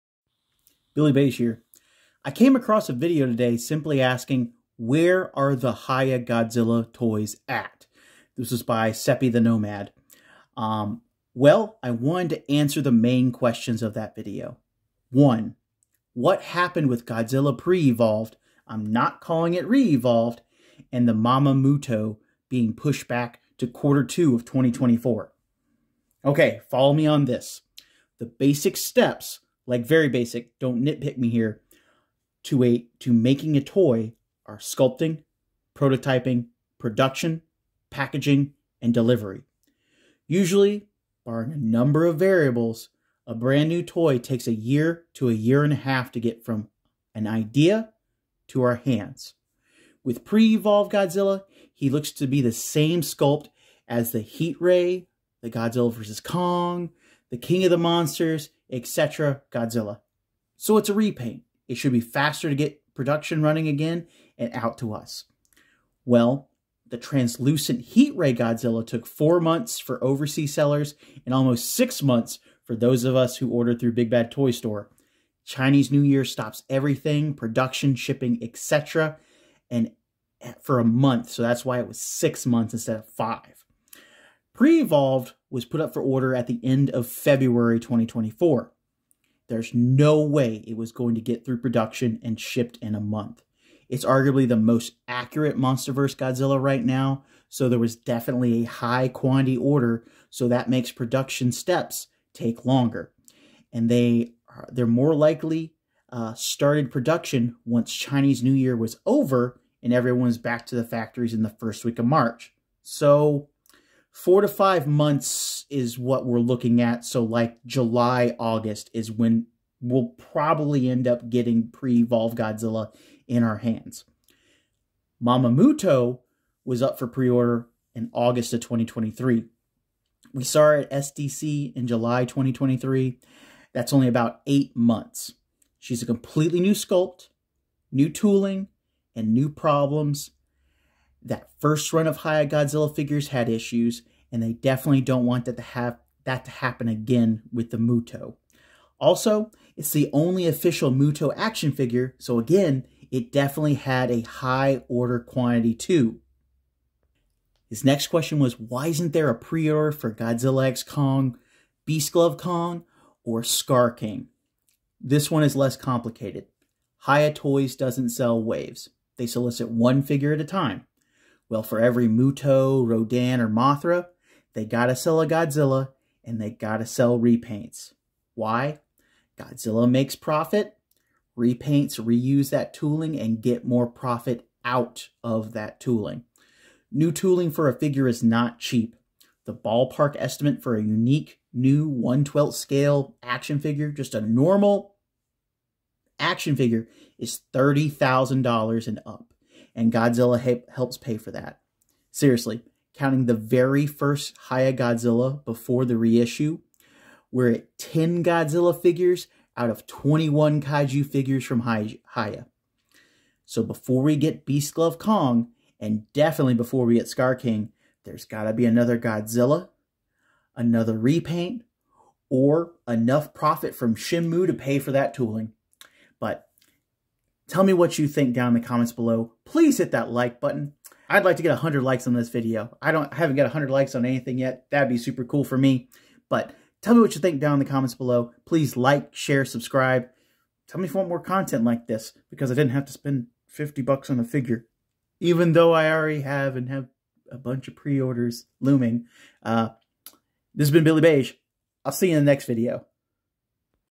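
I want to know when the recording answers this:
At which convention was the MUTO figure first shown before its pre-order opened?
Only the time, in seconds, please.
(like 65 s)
131 s.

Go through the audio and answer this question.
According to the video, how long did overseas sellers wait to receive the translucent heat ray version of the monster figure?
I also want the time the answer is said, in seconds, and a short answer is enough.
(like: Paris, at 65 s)
4 months, at 69 s.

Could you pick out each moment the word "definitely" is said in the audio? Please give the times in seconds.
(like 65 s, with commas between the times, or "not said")
97 s, 144 s, 153 s, 216 s.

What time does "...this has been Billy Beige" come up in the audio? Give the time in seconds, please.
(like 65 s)
250 s.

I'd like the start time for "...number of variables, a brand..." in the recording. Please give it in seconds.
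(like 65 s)
41 s.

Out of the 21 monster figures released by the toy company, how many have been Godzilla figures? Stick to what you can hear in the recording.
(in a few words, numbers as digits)
10.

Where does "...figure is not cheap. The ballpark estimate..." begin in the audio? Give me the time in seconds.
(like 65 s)
187 s.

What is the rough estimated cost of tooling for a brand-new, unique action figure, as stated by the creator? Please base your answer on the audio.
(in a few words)
$30,000.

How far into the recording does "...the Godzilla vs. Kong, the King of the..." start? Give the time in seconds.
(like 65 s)
55 s.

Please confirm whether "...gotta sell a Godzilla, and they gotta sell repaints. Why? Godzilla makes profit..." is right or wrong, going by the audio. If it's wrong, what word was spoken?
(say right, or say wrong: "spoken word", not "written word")
right.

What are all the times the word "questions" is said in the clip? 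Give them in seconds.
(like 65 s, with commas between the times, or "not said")
13 s, 158 s.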